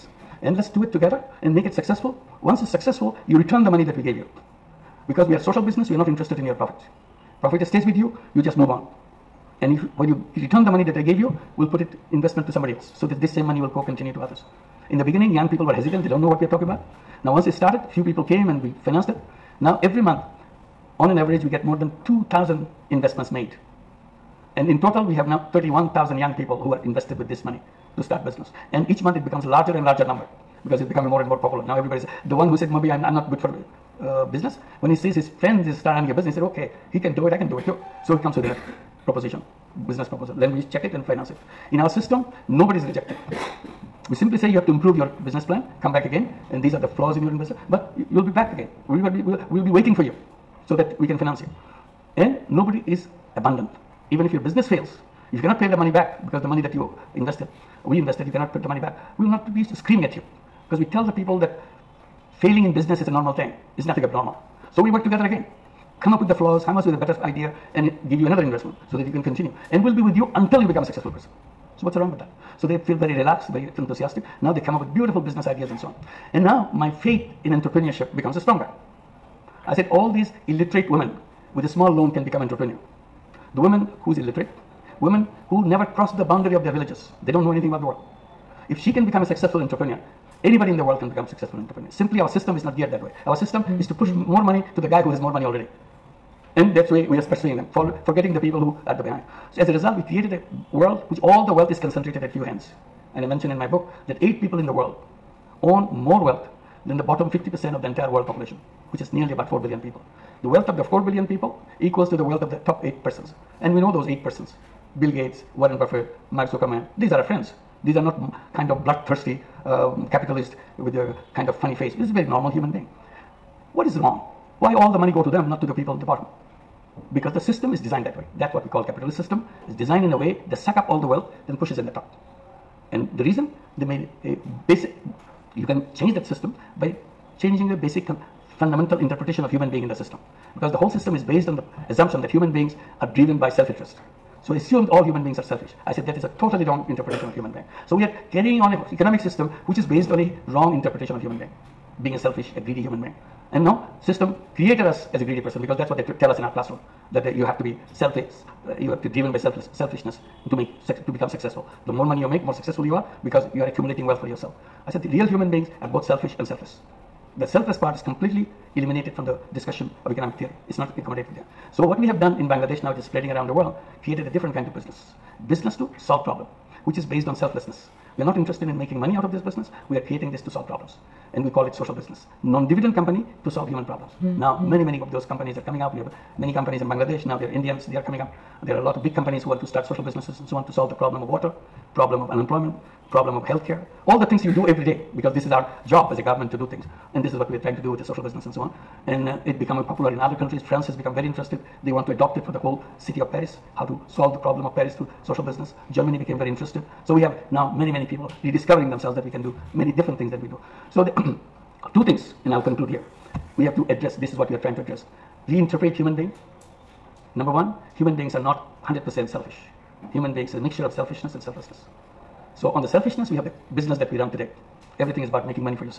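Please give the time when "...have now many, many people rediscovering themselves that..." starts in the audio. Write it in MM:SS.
03:27.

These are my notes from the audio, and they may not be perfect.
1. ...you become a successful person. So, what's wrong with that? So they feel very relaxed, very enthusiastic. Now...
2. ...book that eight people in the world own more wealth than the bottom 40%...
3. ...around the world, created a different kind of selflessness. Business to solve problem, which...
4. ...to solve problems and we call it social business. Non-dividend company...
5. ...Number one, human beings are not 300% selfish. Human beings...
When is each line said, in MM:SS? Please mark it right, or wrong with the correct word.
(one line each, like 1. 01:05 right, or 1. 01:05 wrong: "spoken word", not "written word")
1. 01:10 right
2. 01:43 wrong: "50", not "40"
3. 02:53 wrong: "business", not "selflessness"
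4. 03:00 right
5. 03:37 wrong: "100", not "300".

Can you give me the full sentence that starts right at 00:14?
In the beginning, young people were hesitant, they don't know what we are talking about.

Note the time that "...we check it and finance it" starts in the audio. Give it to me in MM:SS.
00:40.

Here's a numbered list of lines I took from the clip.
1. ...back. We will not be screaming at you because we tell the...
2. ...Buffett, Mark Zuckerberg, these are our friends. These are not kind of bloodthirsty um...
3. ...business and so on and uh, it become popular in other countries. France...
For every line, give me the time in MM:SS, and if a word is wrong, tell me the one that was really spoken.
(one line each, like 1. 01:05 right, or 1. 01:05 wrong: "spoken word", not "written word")
1. 00:58 right
2. 01:55 right
3. 03:18 right.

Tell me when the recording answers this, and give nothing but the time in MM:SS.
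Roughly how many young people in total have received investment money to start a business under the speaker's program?
00:25.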